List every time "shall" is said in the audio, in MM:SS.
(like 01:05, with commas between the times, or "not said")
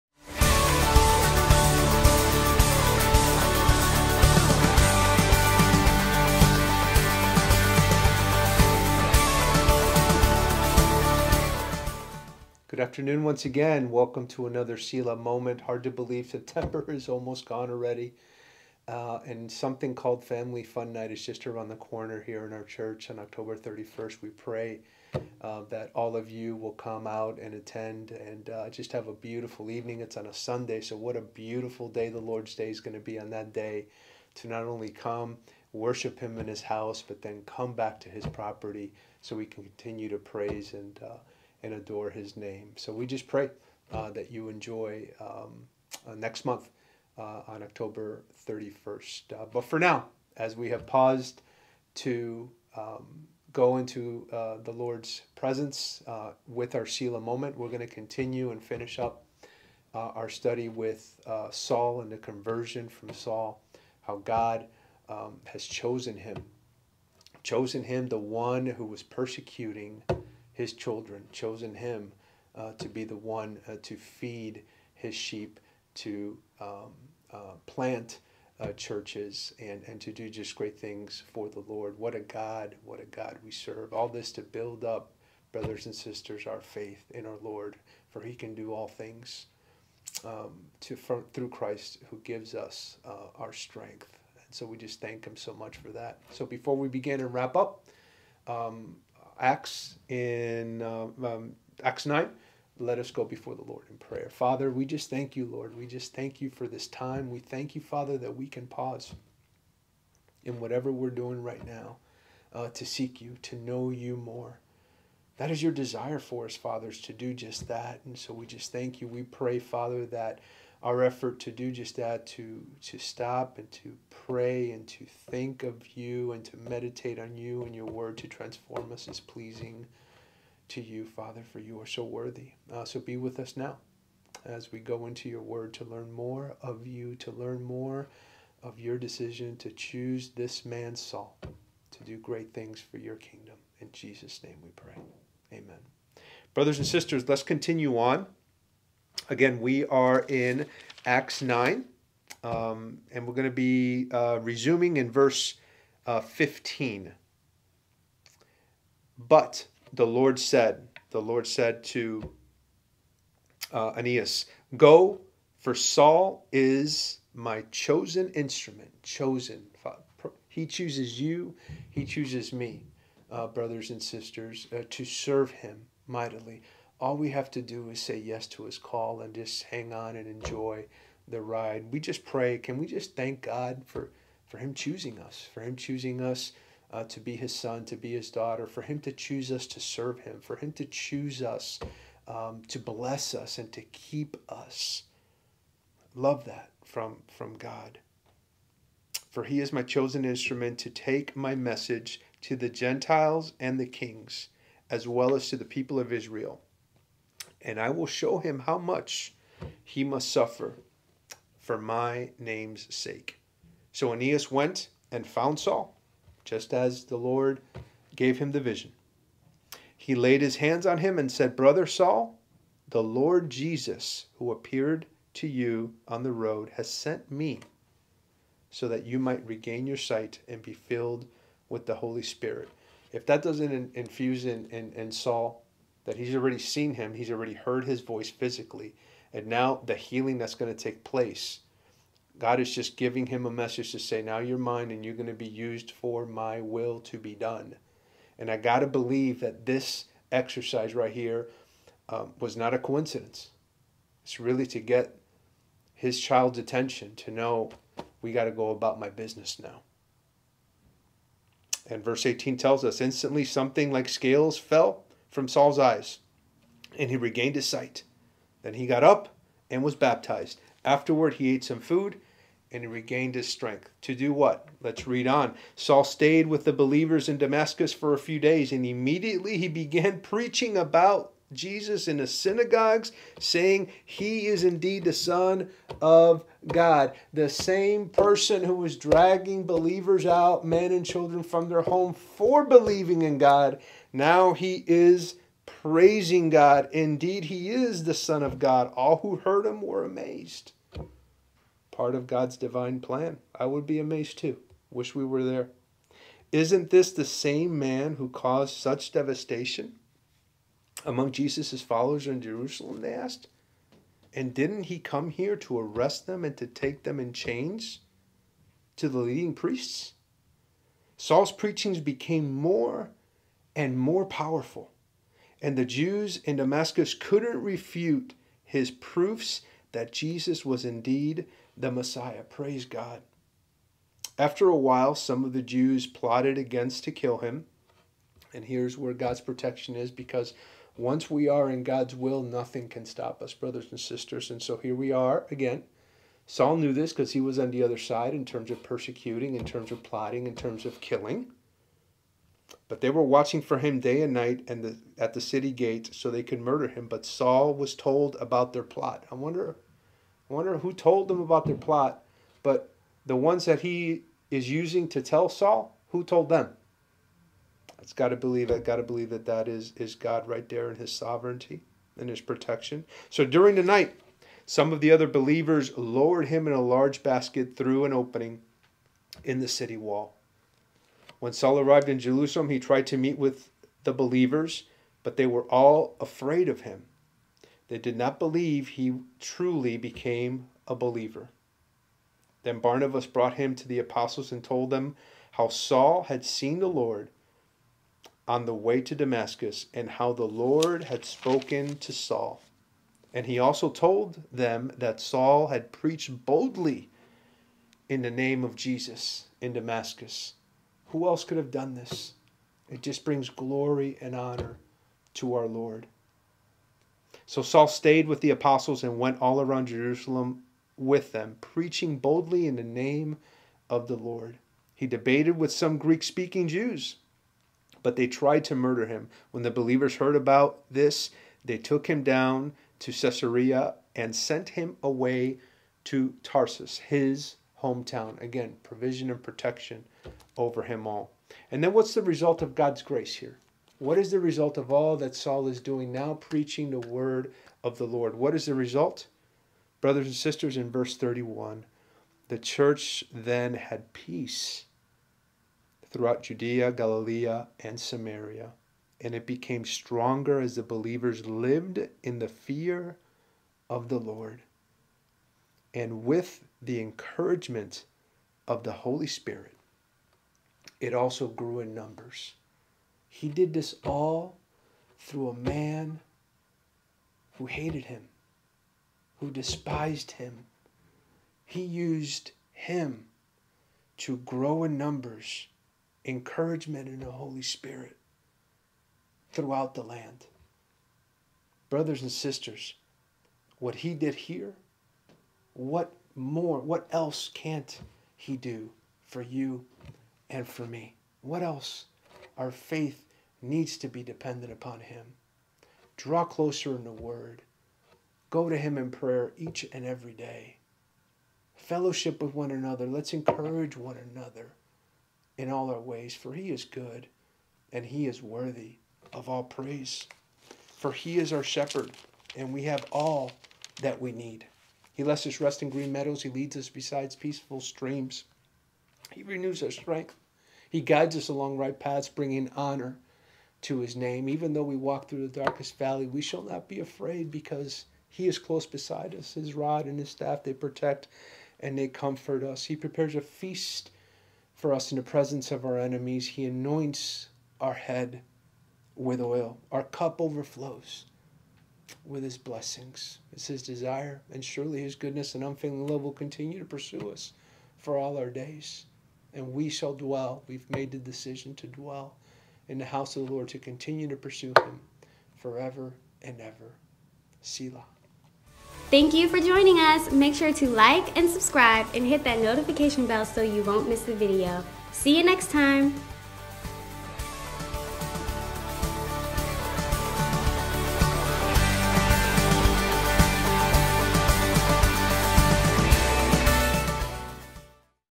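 08:56, 09:19.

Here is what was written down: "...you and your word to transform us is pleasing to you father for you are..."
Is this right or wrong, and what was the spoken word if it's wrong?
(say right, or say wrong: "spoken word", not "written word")
right.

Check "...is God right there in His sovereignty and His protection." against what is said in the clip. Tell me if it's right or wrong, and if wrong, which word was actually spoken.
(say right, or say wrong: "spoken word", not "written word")
right.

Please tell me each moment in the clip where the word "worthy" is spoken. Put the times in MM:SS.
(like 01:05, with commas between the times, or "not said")
02:12, 08:38.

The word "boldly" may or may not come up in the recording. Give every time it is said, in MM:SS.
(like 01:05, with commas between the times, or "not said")
06:46, 07:02.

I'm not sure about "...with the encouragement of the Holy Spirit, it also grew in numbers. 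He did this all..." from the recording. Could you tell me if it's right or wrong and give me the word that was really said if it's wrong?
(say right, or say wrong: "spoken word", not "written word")
right.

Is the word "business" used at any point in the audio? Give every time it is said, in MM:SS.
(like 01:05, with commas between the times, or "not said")
04:19.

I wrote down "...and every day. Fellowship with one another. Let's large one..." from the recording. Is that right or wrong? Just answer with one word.
wrong.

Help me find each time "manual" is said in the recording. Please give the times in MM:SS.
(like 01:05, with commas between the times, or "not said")
not said.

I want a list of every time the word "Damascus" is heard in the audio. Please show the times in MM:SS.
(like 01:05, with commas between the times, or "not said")
04:37, 05:26, 06:39, 06:49.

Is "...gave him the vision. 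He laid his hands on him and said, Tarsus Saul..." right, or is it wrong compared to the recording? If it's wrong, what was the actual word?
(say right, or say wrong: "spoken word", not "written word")
wrong: "Brother", not "Tarsus".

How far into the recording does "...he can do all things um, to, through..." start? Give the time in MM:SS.
01:28.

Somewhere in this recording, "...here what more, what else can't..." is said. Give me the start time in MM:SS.
08:14.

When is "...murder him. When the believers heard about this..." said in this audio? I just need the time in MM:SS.
07:08.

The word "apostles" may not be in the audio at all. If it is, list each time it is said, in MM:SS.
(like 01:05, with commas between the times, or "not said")
06:33, 06:58.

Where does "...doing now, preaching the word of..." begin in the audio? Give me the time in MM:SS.
07:25.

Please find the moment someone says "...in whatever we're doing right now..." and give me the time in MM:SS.
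01:50.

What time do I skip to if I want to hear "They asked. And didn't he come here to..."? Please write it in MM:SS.
05:13.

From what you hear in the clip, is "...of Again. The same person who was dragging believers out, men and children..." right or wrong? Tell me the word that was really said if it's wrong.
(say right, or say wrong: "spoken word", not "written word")
wrong: "God", not "Again".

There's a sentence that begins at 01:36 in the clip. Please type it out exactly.
So before we begin and wrap up, um, Acts in um, um, Acts nine.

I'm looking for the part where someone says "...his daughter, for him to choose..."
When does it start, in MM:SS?
03:08.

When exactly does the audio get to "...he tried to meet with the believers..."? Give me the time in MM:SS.
06:22.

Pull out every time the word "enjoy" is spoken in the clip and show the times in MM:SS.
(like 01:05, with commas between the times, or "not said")
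00:44, 03:00.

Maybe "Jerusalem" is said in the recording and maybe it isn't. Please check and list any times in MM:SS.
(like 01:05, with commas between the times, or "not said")
05:12, 06:22, 06:59.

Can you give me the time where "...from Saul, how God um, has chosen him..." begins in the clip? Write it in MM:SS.
01:02.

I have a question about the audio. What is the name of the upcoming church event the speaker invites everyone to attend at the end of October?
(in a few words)
Family Fun Night.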